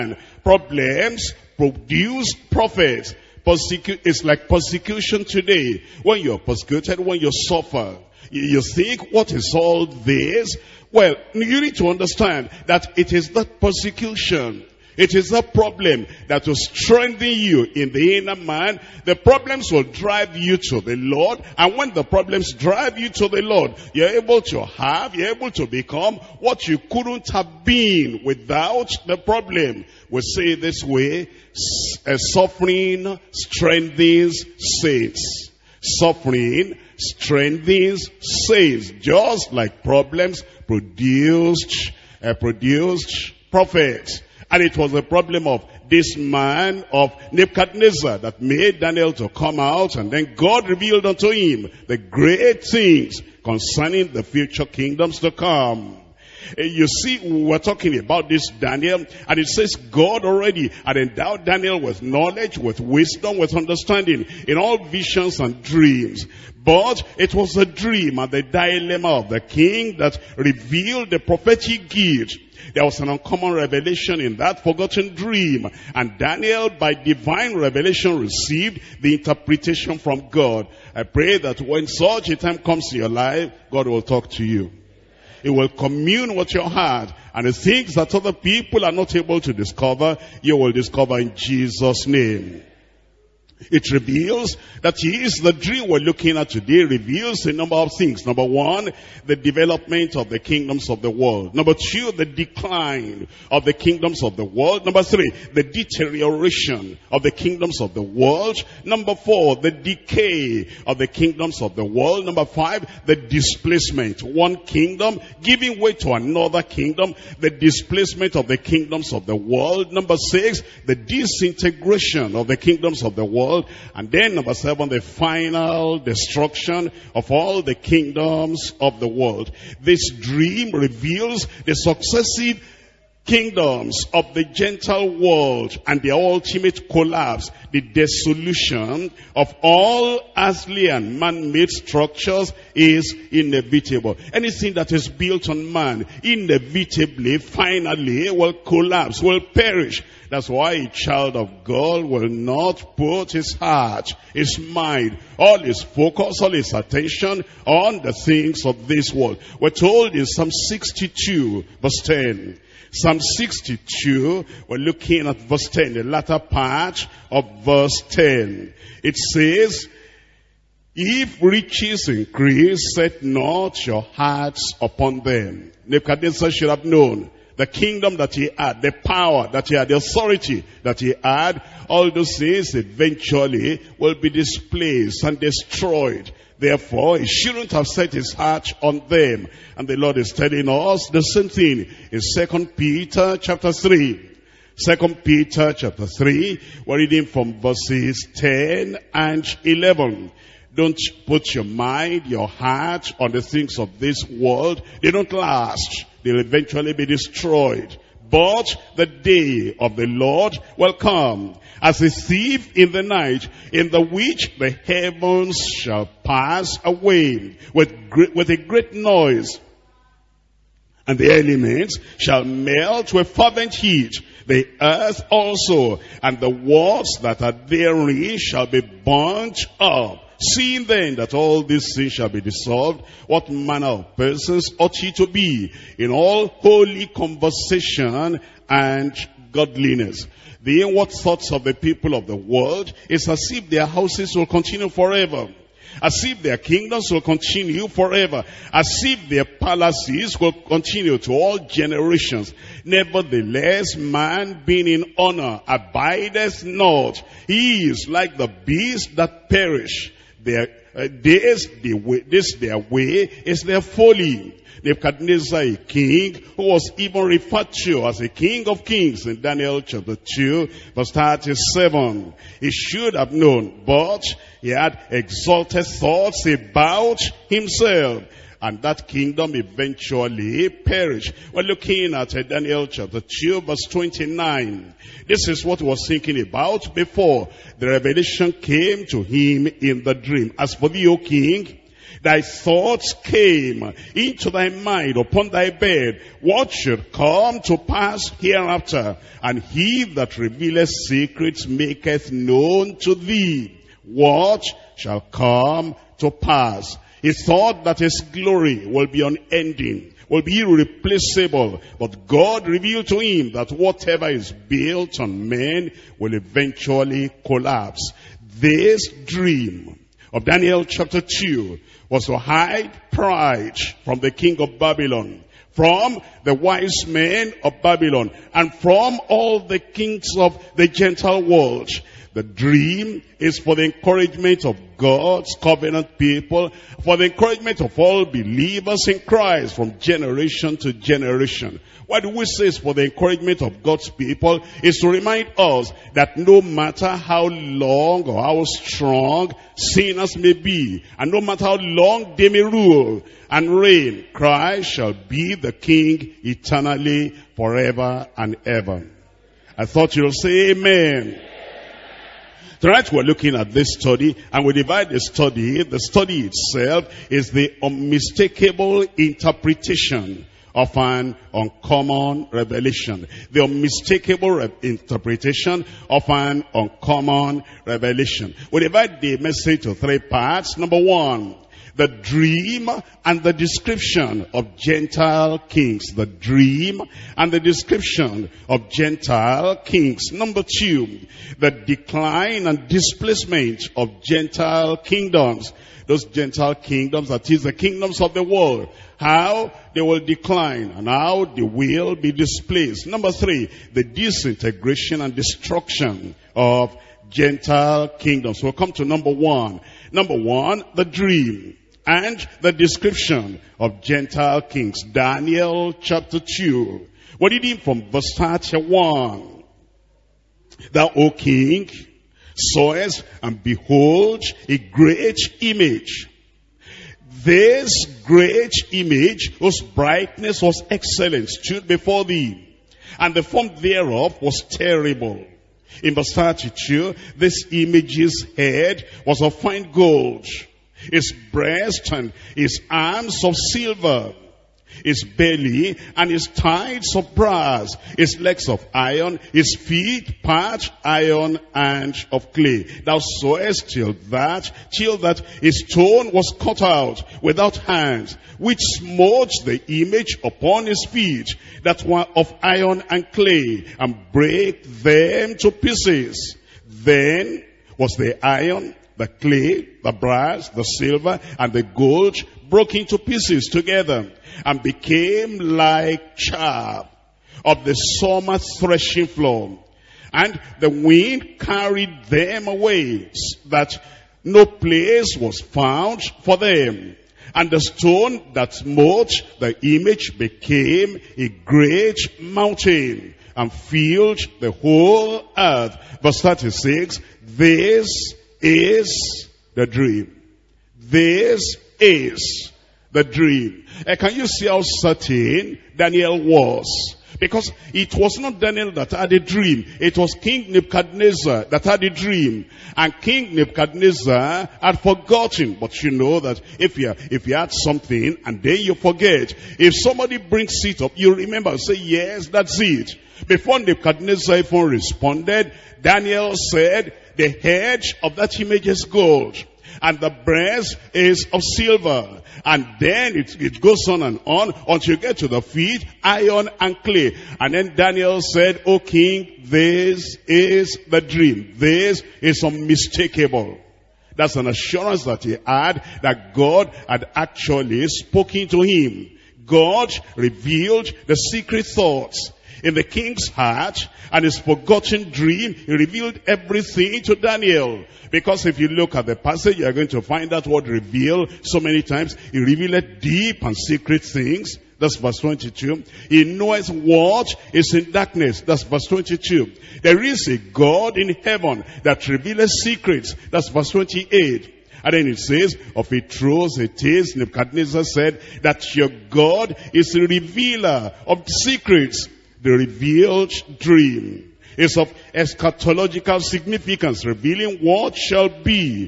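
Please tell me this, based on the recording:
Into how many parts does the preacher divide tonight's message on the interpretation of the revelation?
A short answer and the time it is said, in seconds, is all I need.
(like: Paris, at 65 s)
3, at 379 s.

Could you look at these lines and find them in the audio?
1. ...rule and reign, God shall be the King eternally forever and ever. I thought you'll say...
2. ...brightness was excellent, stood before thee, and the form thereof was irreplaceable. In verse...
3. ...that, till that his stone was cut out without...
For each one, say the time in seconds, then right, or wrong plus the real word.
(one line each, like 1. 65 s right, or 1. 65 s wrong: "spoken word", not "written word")
1. 352 s wrong: "Christ", not "God"
2. 429 s wrong: "terrible", not "irreplaceable"
3. 454 s right.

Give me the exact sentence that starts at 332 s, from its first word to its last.
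The dream is for the encouragement of God's covenant people, for the encouragement of all believers in Christ from generation to generation.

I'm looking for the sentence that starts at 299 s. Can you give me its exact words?
And he that revealeth secrets maketh known to thee what shall come to pass.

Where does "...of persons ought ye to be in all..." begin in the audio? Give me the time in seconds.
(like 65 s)
233 s.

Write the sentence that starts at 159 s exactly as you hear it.
We're told in Psalm 62 verse 10, Psalm 62, we're looking at verse 10, the latter part of verse 10.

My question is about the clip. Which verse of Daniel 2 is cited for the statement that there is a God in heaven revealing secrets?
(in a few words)
Verse 28.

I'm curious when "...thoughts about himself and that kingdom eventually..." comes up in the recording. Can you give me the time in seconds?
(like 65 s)
275 s.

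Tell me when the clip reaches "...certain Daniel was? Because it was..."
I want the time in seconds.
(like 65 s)
504 s.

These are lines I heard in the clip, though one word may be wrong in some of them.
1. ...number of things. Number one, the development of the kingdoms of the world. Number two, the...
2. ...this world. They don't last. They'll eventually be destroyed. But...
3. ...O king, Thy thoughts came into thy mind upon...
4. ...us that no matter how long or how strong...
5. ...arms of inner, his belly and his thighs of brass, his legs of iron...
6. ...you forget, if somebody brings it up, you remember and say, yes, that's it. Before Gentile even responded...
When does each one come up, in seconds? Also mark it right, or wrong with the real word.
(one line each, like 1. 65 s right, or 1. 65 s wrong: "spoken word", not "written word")
1. 97 s right
2. 203 s right
3. 291 s right
4. 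345 s right
5. 442 s wrong: "silver", not "inner"
6. 518 s wrong: "Nebuchadnezzar", not "Gentile".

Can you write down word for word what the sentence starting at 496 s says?
Verse 36, this is the dream.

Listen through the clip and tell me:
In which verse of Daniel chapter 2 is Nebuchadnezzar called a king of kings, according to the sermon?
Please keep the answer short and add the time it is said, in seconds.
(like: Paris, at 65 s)
Verse 37, at 269 s.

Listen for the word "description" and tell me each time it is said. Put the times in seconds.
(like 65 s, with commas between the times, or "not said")
383 s, 387 s, 412 s.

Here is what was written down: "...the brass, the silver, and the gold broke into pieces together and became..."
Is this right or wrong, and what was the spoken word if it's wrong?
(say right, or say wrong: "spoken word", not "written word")
right.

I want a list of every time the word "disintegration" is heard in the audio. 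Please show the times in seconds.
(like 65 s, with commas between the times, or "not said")
120 s, 404 s.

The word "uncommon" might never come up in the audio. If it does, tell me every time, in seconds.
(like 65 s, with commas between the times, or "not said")
73 s, 371 s, 376 s.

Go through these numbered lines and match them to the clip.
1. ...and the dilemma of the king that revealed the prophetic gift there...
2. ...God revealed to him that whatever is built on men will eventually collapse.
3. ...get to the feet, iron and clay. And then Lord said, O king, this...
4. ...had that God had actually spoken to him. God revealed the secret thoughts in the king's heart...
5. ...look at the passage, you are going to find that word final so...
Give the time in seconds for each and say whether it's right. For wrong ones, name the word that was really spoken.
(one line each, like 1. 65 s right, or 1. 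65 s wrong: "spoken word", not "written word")
1. 68 s right
2. 312 s right
3. 535 s wrong: "Daniel", not "Lord"
4. 545 s right
5. 558 s wrong: "reveal", not "final".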